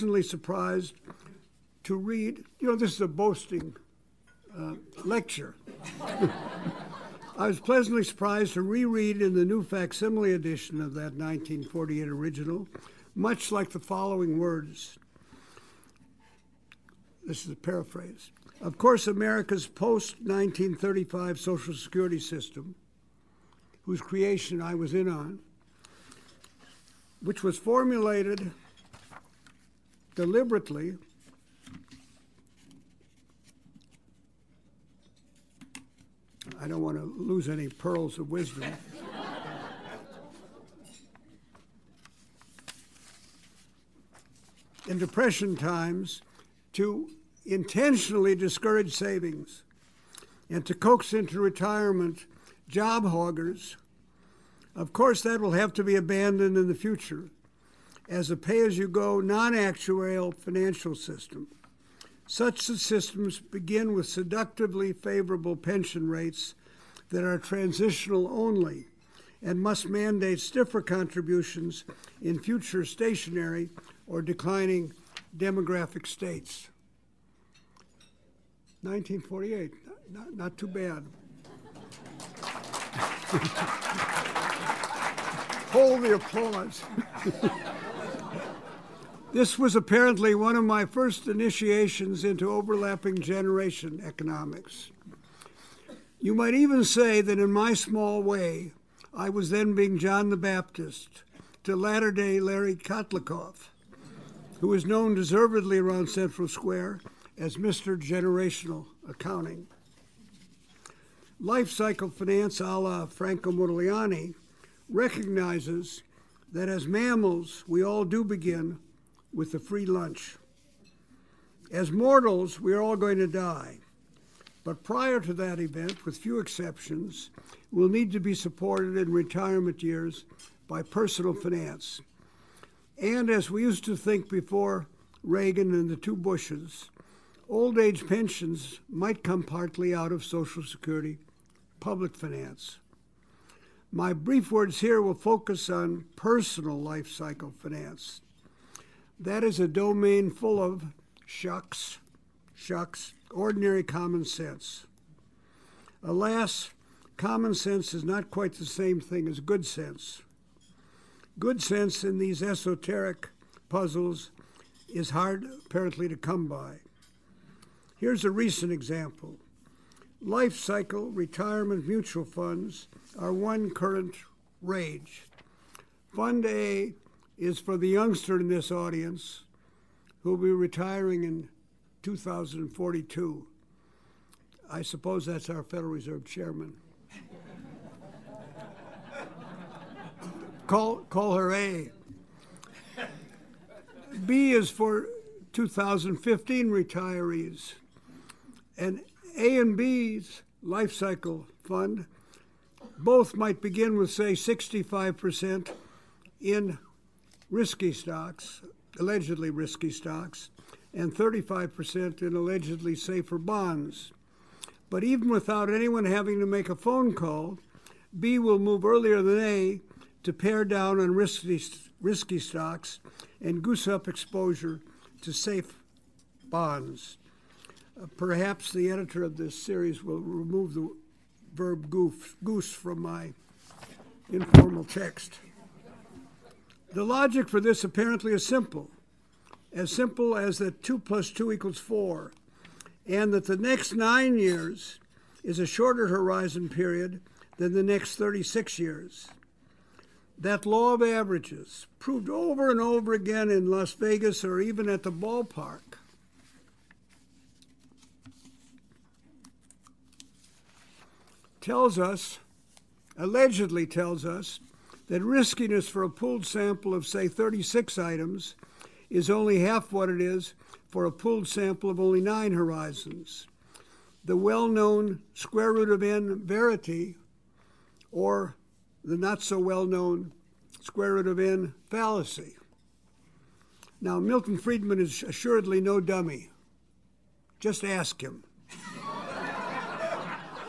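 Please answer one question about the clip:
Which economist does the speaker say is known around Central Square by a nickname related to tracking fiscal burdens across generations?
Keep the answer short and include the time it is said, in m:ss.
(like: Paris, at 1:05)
Larry Kotlikoff, at 1:42.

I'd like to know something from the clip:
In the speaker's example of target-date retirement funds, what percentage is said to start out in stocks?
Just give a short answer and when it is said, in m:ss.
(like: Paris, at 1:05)
65%, at 3:24.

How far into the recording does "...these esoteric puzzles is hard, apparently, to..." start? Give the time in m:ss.
2:42.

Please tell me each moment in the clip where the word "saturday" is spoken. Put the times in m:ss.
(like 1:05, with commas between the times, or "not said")
not said.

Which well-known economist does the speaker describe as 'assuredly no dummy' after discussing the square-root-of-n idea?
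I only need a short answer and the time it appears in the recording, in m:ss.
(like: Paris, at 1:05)
Milton Friedman, at 4:44.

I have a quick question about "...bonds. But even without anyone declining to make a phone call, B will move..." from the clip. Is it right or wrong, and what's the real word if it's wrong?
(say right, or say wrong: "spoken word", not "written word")
wrong: "having", not "declining".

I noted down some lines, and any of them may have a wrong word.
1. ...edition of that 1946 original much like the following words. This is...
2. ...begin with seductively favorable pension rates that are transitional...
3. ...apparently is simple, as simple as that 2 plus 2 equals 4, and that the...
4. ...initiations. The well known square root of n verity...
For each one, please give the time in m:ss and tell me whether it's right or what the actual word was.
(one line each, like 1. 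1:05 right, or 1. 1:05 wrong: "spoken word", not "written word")
1. 0:10 wrong: "1948", not "1946"
2. 1:03 right
3. 3:57 right
4. 4:32 wrong: "horizons", not "initiations".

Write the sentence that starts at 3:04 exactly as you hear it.
I suppose that's our Federal Reserve Chairman.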